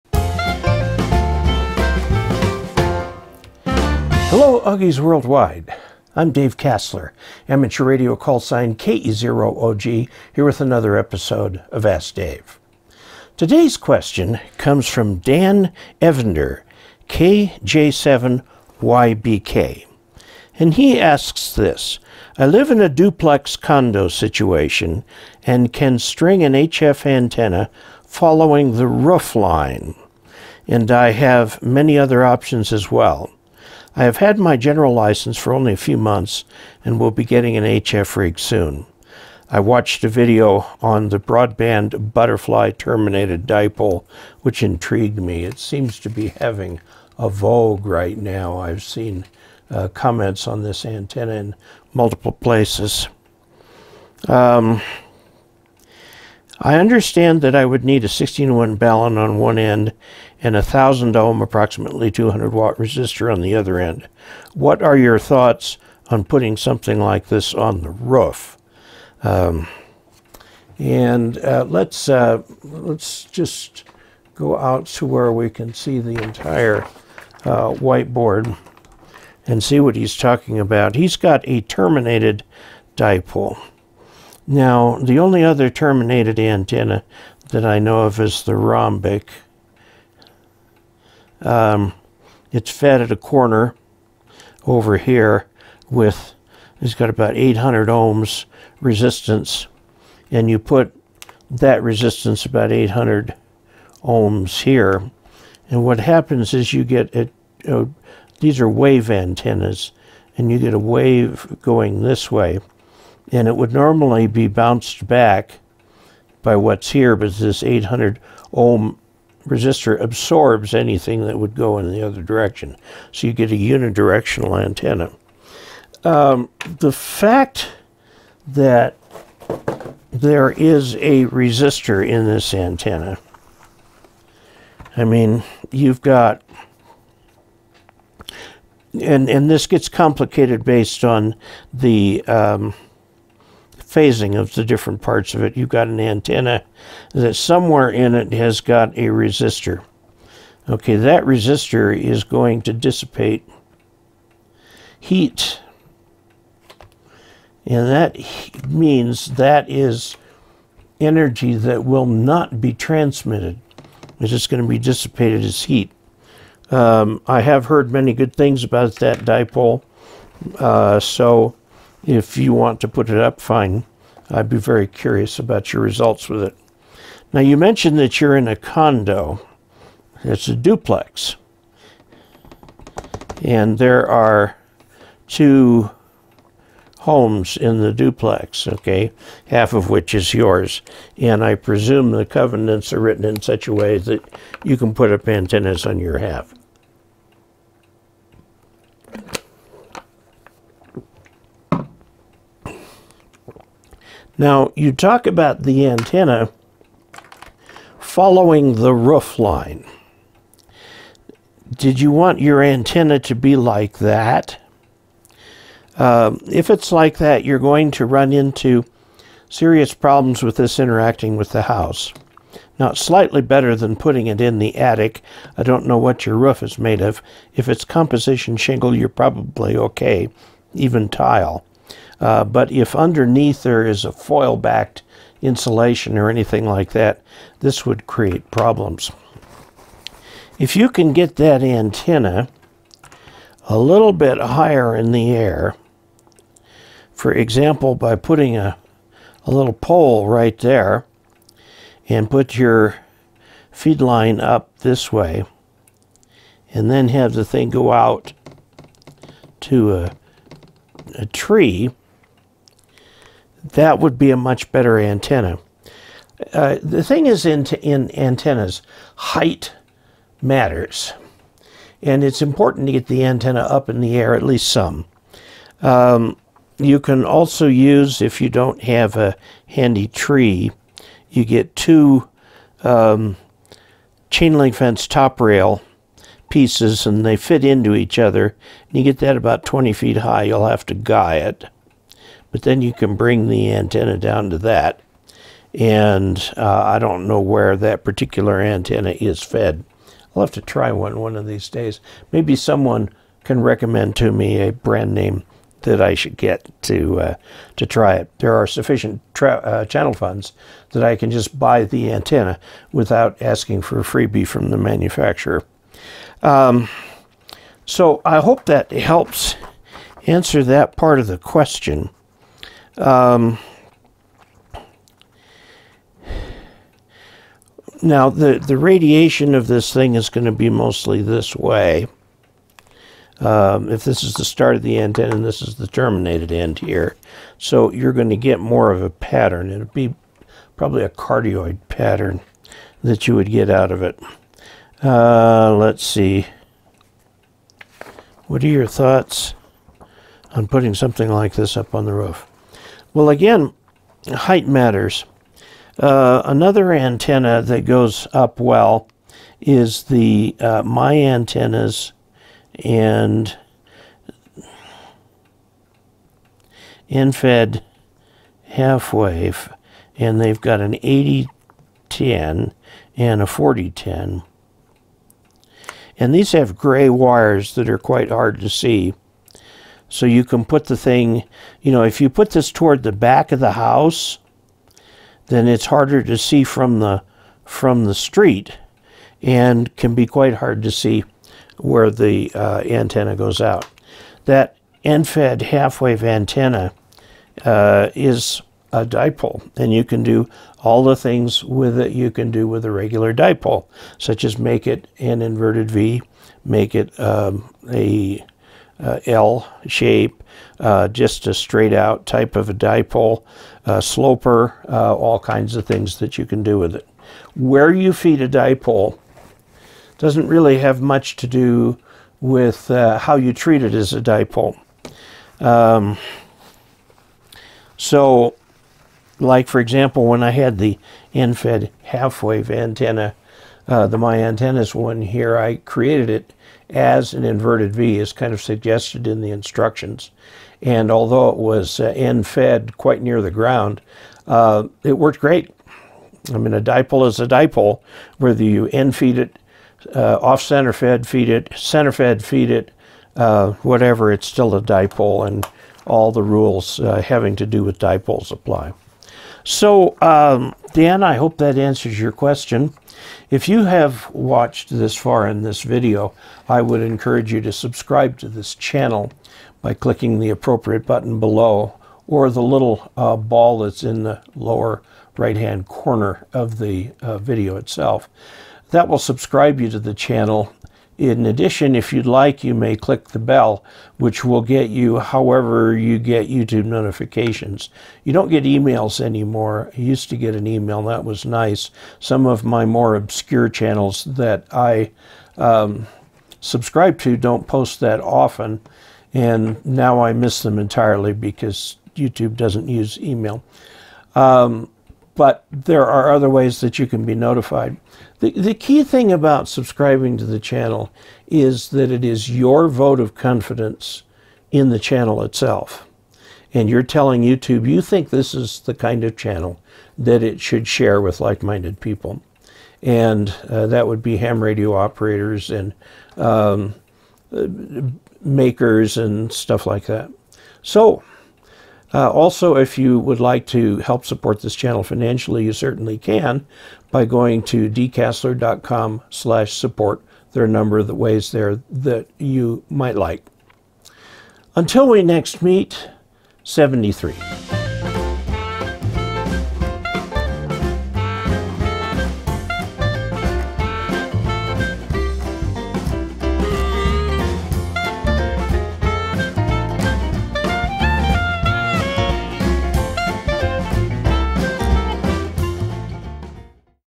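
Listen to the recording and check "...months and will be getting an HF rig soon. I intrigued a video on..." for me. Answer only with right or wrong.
wrong.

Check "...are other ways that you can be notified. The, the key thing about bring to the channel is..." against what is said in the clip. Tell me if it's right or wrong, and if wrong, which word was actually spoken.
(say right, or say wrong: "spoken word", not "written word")
wrong: "subscribing", not "bring".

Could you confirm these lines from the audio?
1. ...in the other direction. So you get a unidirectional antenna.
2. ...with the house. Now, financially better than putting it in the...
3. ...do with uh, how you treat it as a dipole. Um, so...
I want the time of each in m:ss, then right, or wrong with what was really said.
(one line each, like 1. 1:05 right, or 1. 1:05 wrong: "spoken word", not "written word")
1. 2:01 right
2. 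3:41 wrong: "slightly", not "financially"
3. 7:01 right.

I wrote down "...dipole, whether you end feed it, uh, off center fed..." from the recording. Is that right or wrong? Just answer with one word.
right.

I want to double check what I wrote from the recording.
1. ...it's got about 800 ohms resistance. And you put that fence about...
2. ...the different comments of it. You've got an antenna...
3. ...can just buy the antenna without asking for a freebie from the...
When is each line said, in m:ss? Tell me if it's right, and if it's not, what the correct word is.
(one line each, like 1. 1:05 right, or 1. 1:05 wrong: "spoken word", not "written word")
1. 1:36 wrong: "resistance", not "fence"
2. 2:24 wrong: "parts", not "comments"
3. 5:11 right.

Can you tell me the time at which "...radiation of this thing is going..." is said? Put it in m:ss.
5:28.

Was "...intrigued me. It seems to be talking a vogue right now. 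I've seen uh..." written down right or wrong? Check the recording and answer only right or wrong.
wrong.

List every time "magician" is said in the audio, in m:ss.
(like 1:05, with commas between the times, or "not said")
not said.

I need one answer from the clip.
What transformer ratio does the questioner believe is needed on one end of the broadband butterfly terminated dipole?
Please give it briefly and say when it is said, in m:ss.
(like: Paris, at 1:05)
16-1, at 0:58.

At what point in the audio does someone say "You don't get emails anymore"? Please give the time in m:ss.
8:08.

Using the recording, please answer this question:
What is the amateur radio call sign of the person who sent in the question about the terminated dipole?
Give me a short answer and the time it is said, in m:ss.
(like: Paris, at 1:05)
KJ7YBK, at 0:17.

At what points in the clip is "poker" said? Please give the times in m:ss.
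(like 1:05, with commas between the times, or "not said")
not said.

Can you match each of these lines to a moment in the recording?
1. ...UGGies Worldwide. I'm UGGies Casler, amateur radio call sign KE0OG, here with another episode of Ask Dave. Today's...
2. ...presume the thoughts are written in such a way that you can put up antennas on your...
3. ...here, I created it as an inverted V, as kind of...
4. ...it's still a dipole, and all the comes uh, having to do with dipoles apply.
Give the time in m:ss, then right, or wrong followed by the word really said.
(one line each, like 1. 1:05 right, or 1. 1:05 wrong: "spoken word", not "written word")
1. 0:04 wrong: "Dave", not "UGGies"
2. 3:11 wrong: "covenants", not "thoughts"
3. 7:15 right
4. 7:34 wrong: "rules", not "comes".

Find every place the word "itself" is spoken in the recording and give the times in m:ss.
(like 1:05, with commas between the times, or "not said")
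7:57, 8:35.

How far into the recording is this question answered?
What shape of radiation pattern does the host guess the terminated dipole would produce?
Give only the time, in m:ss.
5:41.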